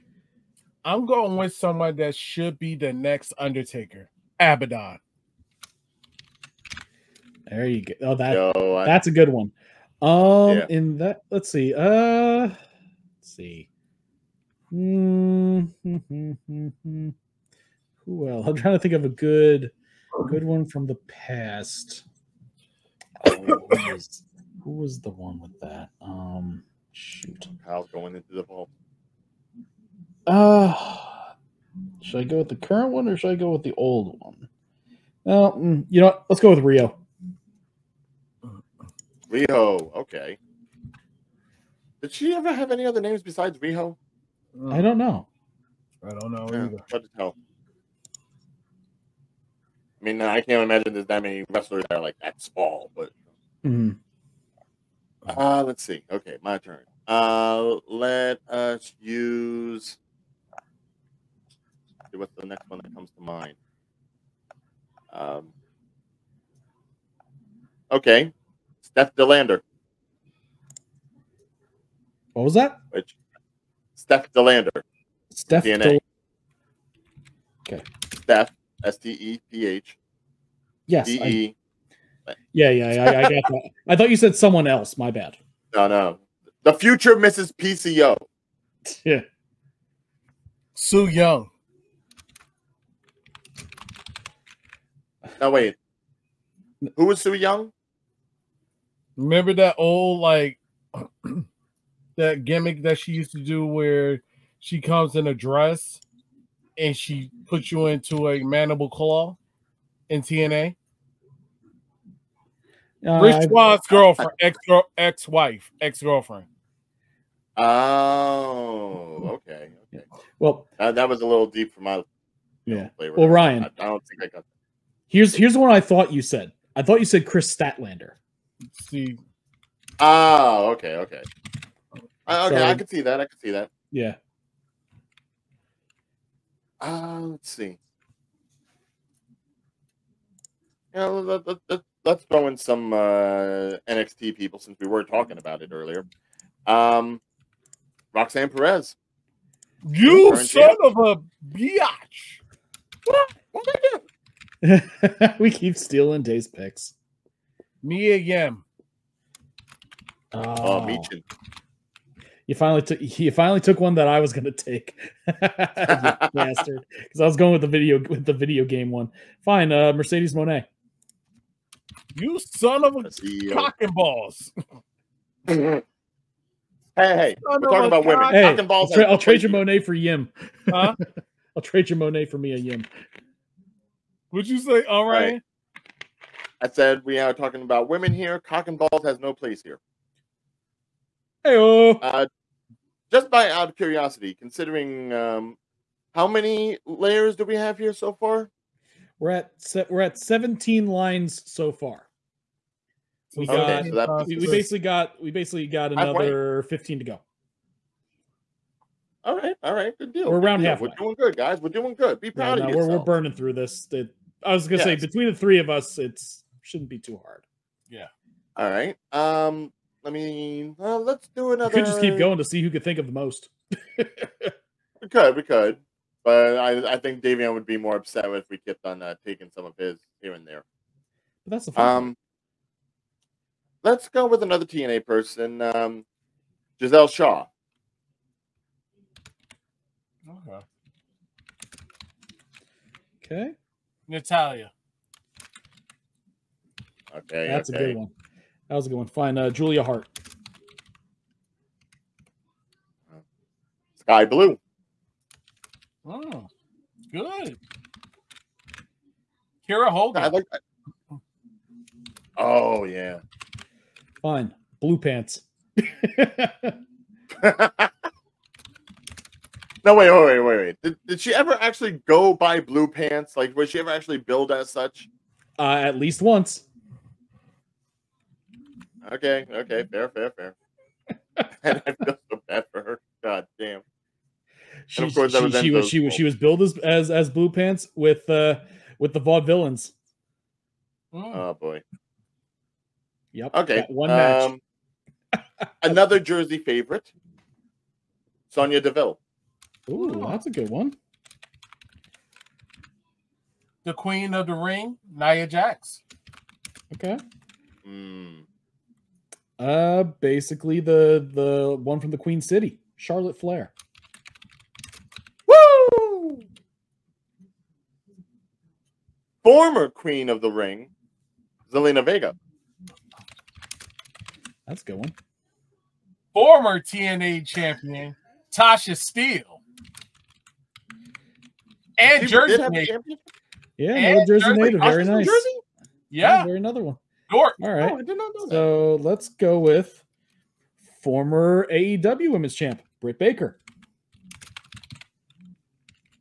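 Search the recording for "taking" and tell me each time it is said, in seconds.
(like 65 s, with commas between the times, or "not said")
229 s.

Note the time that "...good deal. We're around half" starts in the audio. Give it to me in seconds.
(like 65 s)
209 s.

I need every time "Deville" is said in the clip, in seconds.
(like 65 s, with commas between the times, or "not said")
298 s.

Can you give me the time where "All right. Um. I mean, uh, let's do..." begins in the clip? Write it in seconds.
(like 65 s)
218 s.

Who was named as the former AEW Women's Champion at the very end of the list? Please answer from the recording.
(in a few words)
Britt Baker.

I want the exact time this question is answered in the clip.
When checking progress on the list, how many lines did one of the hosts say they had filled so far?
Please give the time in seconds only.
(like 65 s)
200 s.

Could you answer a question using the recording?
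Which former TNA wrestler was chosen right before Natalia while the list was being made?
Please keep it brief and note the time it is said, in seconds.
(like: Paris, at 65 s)
Giselle Shaw, at 236 s.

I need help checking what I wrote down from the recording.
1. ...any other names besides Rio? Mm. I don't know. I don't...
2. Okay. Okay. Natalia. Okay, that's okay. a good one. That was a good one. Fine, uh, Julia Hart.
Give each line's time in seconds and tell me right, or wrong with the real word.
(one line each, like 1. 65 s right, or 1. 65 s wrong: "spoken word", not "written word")
1. 42 s right
2. 240 s right.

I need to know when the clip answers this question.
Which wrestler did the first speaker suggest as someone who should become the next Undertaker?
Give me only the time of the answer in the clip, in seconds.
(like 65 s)
4 s.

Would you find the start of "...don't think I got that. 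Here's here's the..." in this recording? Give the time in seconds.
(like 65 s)
123 s.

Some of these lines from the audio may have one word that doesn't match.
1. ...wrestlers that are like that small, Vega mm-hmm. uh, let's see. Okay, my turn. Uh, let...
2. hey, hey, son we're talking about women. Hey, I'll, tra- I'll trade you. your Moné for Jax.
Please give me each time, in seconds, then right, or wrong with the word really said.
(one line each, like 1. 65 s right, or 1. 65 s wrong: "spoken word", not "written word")
1. 51 s wrong: "But", not "Vega"
2. 175 s wrong: "Yim", not "Jax".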